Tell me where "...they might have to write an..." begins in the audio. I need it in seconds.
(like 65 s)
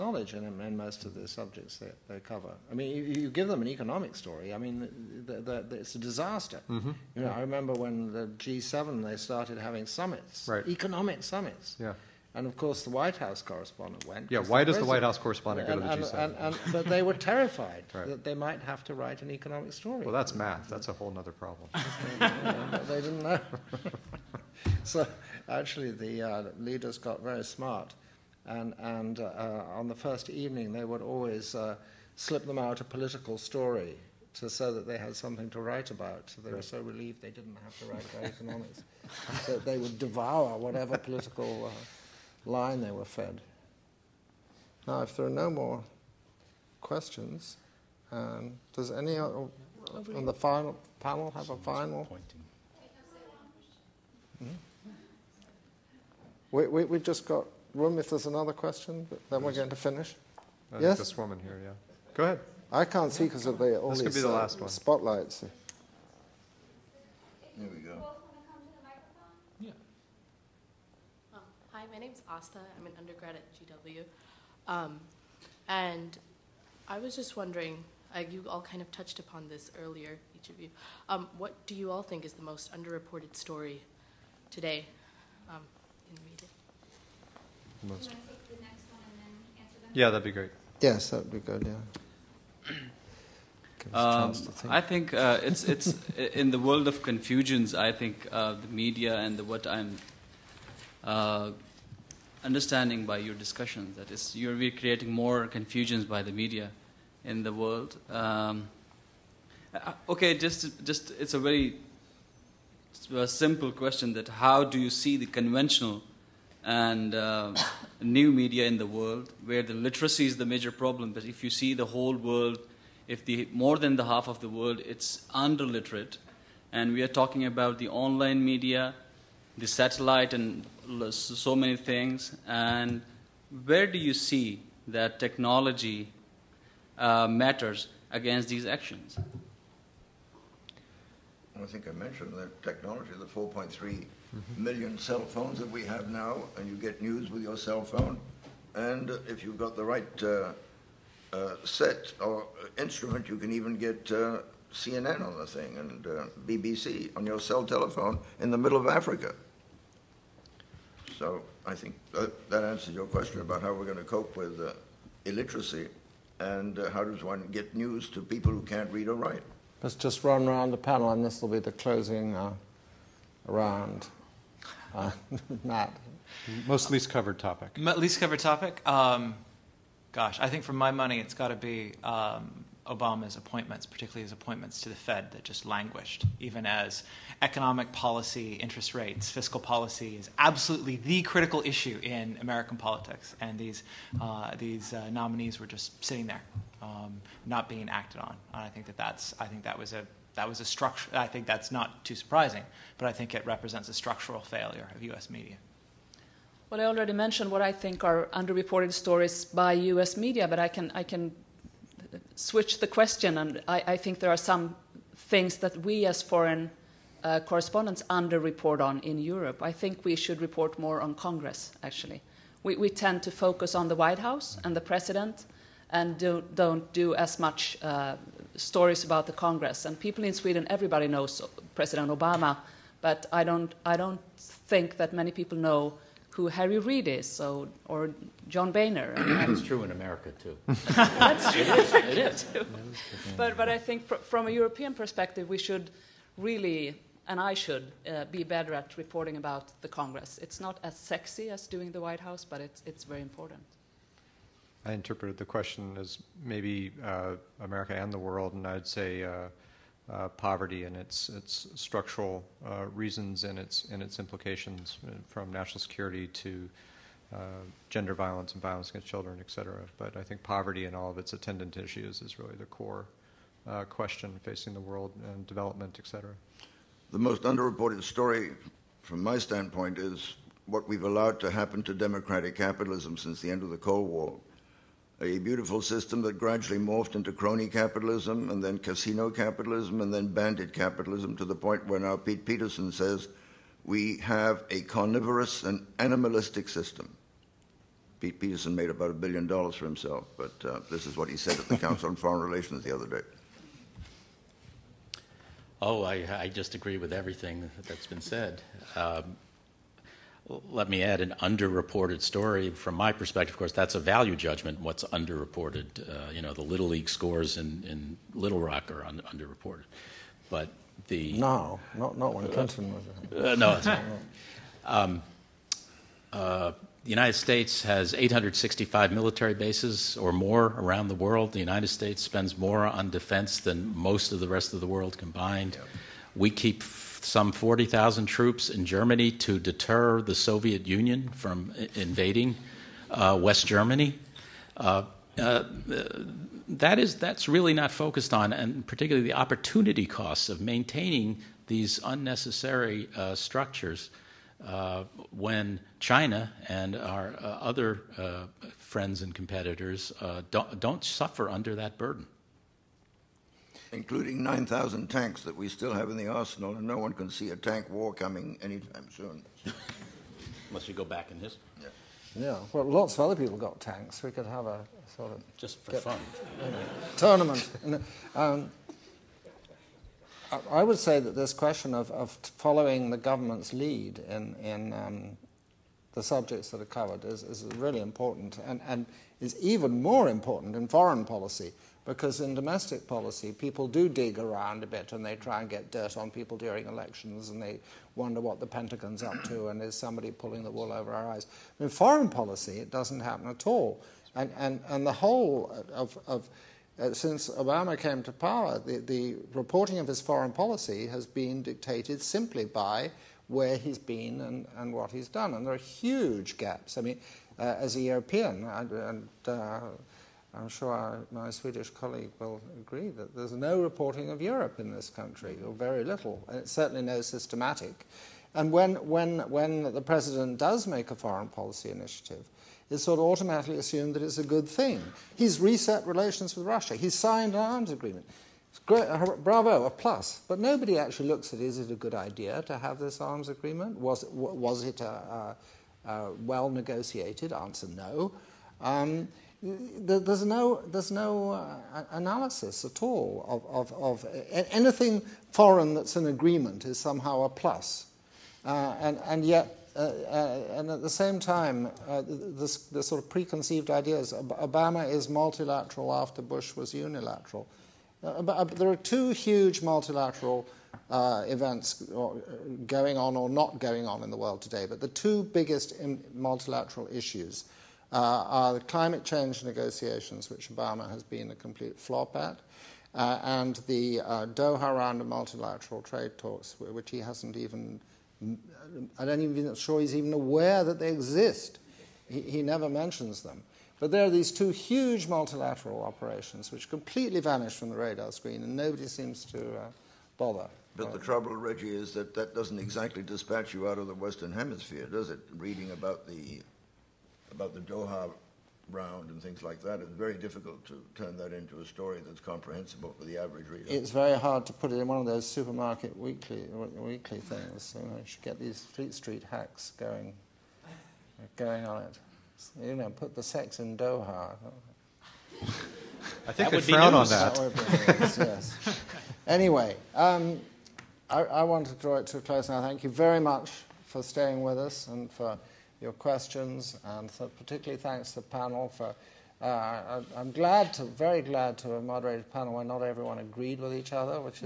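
18 s.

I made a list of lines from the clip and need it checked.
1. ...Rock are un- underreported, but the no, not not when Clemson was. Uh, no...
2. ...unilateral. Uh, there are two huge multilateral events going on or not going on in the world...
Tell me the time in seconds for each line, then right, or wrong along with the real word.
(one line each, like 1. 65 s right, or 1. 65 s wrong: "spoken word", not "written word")
1. 318 s right
2. 466 s right.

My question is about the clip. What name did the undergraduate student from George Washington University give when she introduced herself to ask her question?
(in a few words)
Asta.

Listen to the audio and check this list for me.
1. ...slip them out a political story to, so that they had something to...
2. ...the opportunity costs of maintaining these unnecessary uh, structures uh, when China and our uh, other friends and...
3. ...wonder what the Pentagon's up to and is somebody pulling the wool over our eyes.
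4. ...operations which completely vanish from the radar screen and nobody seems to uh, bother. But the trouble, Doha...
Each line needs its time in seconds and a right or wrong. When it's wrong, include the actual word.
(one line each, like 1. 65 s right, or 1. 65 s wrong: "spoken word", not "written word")
1. 32 s right
2. 349 s right
3. 398 s right
4. 496 s wrong: "Reggie", not "Doha".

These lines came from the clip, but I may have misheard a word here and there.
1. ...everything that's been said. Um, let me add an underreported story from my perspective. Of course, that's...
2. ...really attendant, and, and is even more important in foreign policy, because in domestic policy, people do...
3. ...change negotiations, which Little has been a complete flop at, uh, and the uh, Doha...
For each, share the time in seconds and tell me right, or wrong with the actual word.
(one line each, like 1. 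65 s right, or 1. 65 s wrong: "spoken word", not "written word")
1. 307 s right
2. 387 s wrong: "important", not "attendant"
3. 479 s wrong: "Obama", not "Little".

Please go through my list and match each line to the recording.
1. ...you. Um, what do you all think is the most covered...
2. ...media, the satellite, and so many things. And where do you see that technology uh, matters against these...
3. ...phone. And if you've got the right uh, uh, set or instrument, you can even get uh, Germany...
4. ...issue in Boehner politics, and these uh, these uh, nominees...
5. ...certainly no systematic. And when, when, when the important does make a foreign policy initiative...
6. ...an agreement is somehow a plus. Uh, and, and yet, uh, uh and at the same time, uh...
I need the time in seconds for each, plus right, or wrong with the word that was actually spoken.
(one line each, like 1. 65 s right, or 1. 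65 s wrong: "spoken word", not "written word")
1. 80 s wrong: "underreported", not "covered"
2. 128 s right
3. 147 s wrong: "CNN", not "Germany"
4. 191 s wrong: "American", not "Boehner"
5. 426 s wrong: "president", not "important"
6. 456 s right.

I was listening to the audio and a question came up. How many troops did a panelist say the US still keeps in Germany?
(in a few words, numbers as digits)
40,000.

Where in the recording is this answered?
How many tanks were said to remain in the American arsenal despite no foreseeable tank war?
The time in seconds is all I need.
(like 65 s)
364 s.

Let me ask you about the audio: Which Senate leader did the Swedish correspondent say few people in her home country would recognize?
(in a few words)
Harry Reid.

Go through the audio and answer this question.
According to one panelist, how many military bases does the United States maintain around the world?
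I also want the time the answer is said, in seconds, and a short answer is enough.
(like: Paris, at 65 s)
865, at 328 s.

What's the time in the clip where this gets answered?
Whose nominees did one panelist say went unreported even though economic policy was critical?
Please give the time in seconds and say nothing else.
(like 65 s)
184 s.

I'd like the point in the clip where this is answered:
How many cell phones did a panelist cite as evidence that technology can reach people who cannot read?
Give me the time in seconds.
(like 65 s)
143 s.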